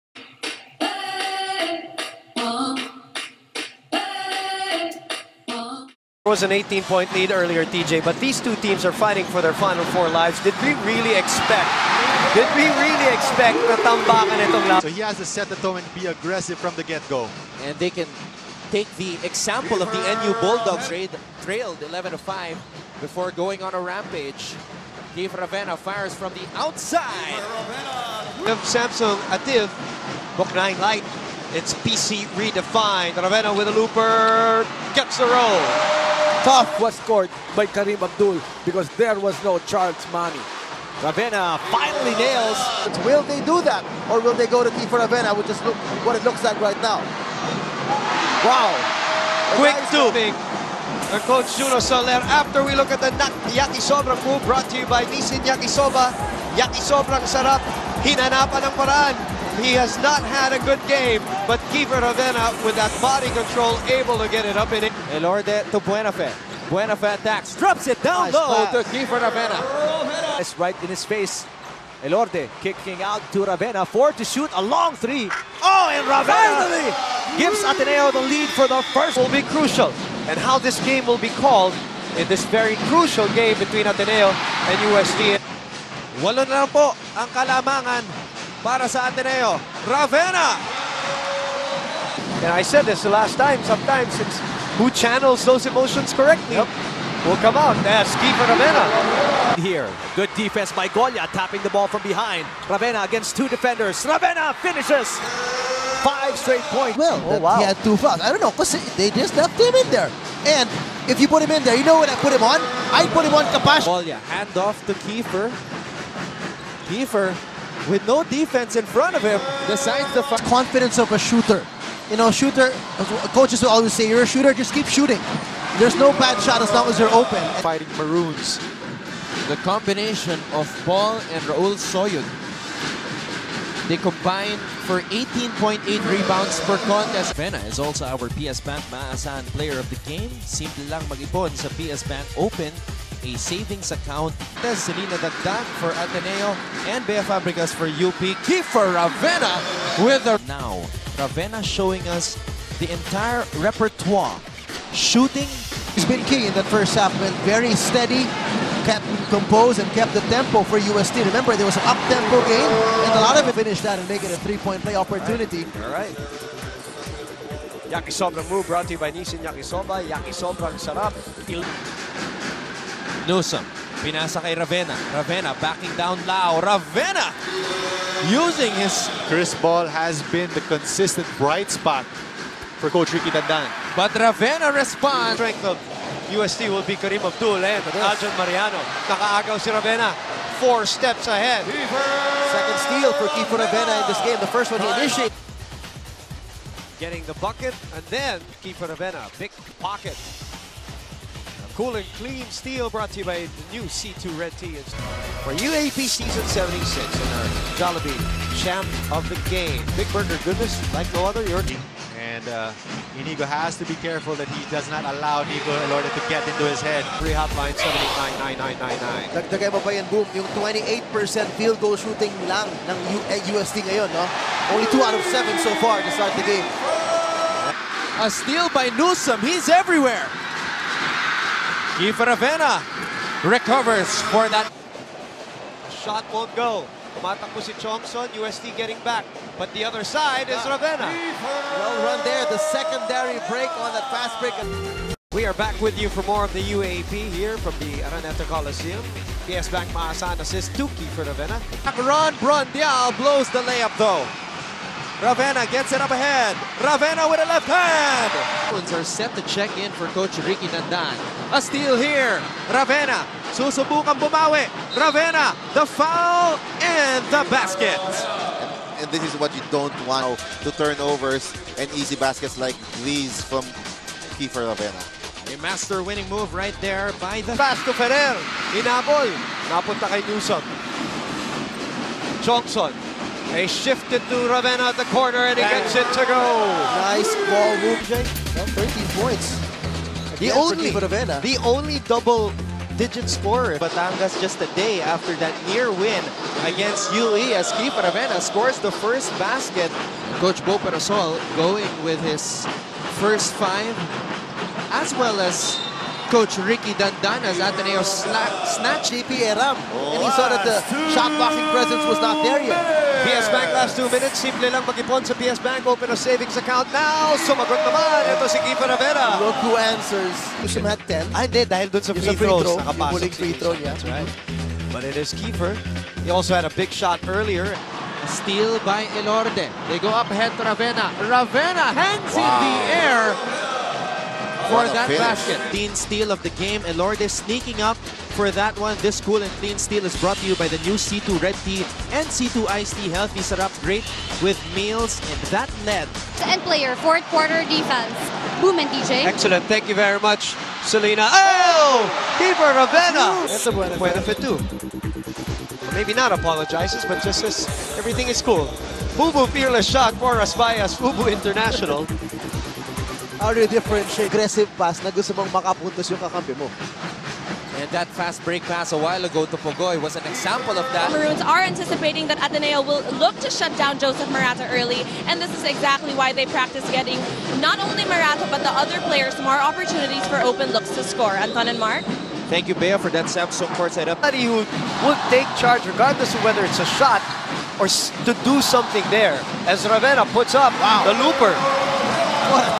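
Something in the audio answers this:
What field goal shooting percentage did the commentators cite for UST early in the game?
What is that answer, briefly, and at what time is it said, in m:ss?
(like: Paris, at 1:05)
28%, at 3:40.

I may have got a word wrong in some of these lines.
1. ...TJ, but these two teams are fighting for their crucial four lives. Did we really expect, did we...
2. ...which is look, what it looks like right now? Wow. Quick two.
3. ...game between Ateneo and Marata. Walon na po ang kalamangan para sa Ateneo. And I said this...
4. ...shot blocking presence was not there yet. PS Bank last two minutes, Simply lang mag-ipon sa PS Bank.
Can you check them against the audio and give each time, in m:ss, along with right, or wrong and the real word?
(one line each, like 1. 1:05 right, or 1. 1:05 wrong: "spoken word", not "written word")
1. 0:07 wrong: "final", not "crucial"
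2. 0:45 right
3. 1:23 wrong: "UST", not "Marata"
4. 5:11 right.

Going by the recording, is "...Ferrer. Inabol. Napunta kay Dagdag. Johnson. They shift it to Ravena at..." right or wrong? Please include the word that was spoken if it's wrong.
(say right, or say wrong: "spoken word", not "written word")
wrong: "Newsome", not "Dagdag".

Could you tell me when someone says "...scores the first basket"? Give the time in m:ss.
4:58.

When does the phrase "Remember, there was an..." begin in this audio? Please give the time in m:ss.
2:41.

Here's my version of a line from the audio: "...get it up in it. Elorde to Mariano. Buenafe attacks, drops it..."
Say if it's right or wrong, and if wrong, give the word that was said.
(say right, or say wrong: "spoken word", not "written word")
wrong: "Buenafe", not "Mariano".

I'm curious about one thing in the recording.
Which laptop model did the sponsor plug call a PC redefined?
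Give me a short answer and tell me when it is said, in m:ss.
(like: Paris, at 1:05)
Samsung ATIV Book 9 Lite, at 0:28.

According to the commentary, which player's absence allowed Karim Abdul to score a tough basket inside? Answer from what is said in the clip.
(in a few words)
Charles Mammie.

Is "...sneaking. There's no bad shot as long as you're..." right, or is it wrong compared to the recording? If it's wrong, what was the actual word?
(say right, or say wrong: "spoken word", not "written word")
wrong: "shooting", not "sneaking".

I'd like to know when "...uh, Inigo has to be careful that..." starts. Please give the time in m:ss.
3:32.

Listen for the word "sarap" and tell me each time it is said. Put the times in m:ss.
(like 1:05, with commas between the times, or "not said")
0:57, 2:50.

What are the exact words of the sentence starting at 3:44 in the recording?
Only 2 out of 7 so far to start the game.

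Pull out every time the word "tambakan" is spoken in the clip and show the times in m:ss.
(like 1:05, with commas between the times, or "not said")
0:13.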